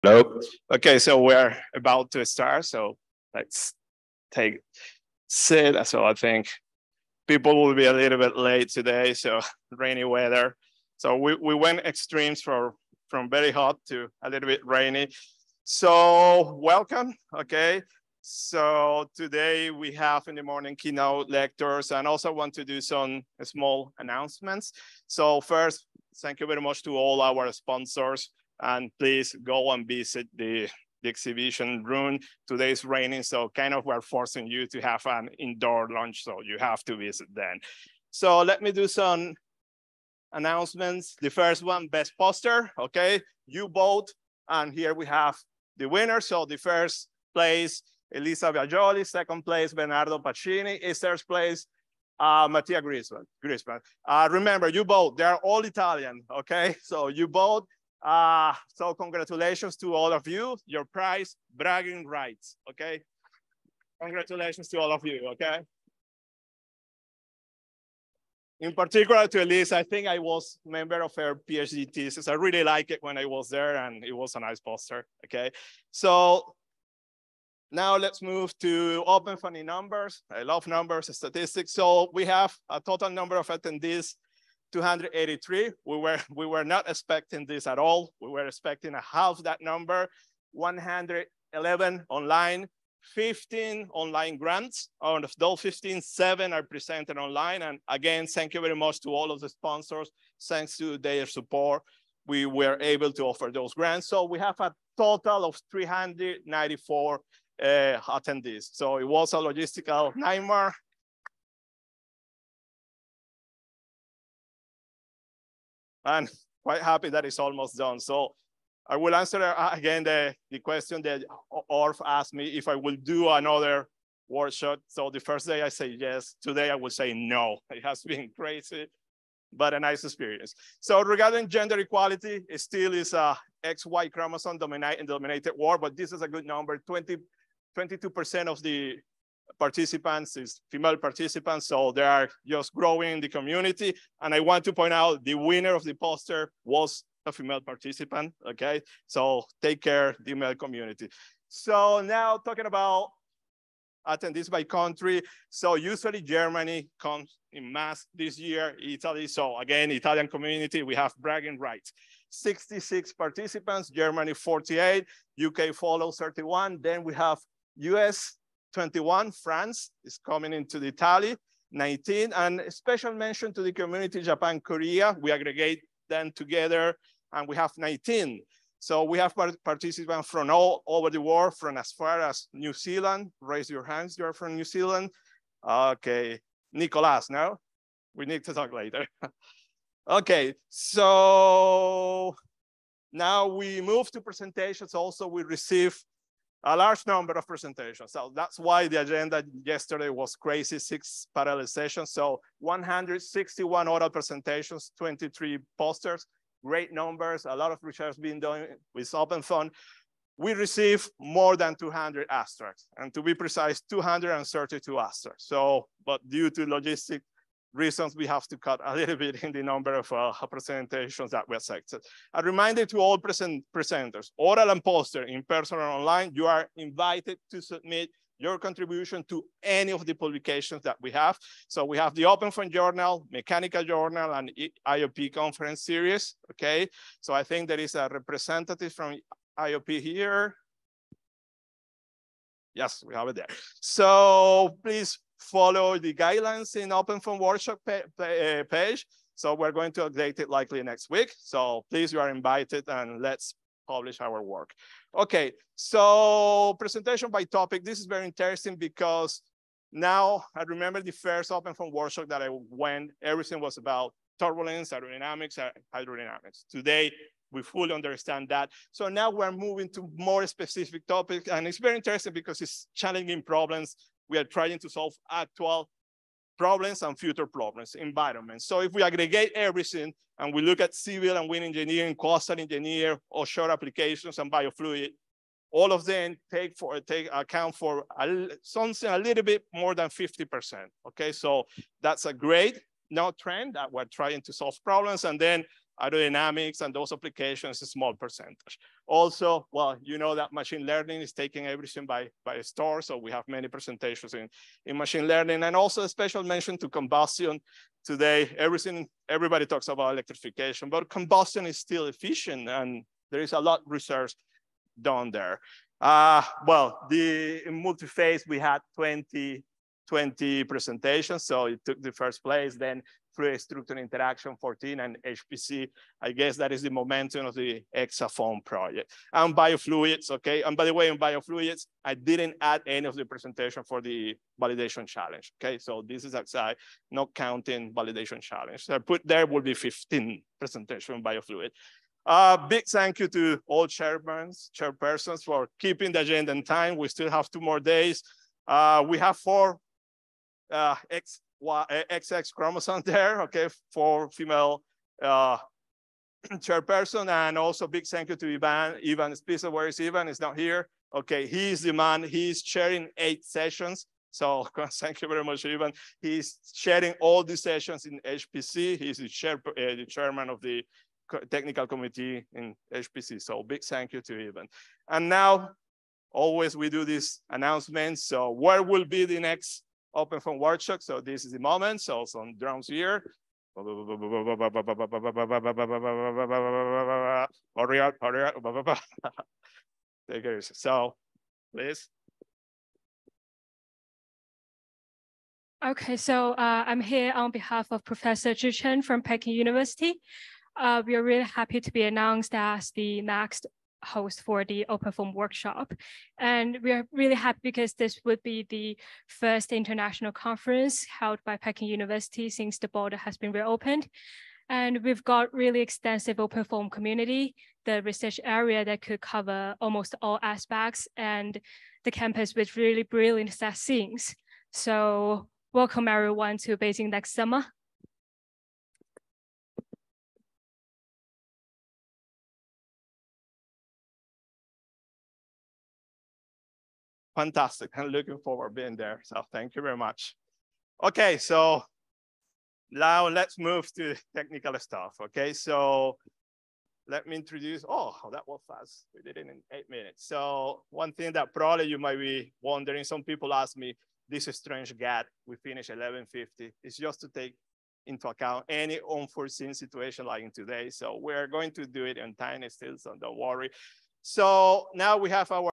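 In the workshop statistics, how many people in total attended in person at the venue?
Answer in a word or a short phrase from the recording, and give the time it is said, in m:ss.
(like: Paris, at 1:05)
283, at 1:24.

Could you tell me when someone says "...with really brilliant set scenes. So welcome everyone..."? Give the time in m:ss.
7:02.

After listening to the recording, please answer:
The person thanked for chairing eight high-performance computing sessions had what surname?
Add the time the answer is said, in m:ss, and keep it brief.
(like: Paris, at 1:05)
Spitzer, at 5:59.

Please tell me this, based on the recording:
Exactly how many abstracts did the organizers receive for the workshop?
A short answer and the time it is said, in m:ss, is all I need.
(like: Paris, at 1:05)
232, at 3:33.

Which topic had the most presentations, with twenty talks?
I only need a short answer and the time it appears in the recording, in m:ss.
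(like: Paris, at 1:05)
Multi-phase, at 5:17.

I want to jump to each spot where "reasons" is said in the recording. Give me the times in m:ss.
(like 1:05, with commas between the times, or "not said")
3:37.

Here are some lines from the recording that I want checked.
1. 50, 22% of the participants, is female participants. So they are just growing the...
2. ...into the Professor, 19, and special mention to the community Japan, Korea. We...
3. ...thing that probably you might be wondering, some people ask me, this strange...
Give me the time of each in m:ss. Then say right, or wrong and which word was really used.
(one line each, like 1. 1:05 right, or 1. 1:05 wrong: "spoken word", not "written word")
1. 2:16 wrong: "20", not "50"
2. 2:50 wrong: "Italy", not "Professor"
3. 7:31 right.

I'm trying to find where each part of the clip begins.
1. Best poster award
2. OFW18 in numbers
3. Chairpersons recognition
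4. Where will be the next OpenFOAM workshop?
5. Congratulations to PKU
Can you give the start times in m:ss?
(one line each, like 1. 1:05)
1. 0:45
2. 1:30
3. 5:45
4. 6:20
5. 7:05.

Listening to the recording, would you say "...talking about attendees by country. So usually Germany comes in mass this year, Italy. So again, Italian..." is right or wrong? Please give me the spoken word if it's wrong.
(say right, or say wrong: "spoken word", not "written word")
right.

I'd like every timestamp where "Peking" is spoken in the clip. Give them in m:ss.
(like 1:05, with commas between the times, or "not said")
6:39, 6:51.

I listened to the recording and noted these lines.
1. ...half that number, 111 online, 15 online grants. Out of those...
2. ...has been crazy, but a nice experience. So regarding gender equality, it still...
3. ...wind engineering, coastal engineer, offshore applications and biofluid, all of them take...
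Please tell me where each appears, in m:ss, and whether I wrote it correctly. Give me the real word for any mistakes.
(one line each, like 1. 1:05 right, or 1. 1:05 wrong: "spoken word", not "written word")
1. 1:29 right
2. 2:07 right
3. 4:41 right.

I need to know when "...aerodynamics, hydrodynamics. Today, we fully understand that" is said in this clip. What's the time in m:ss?
4:24.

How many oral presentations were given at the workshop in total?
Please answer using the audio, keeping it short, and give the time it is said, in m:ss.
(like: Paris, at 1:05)
161, at 3:22.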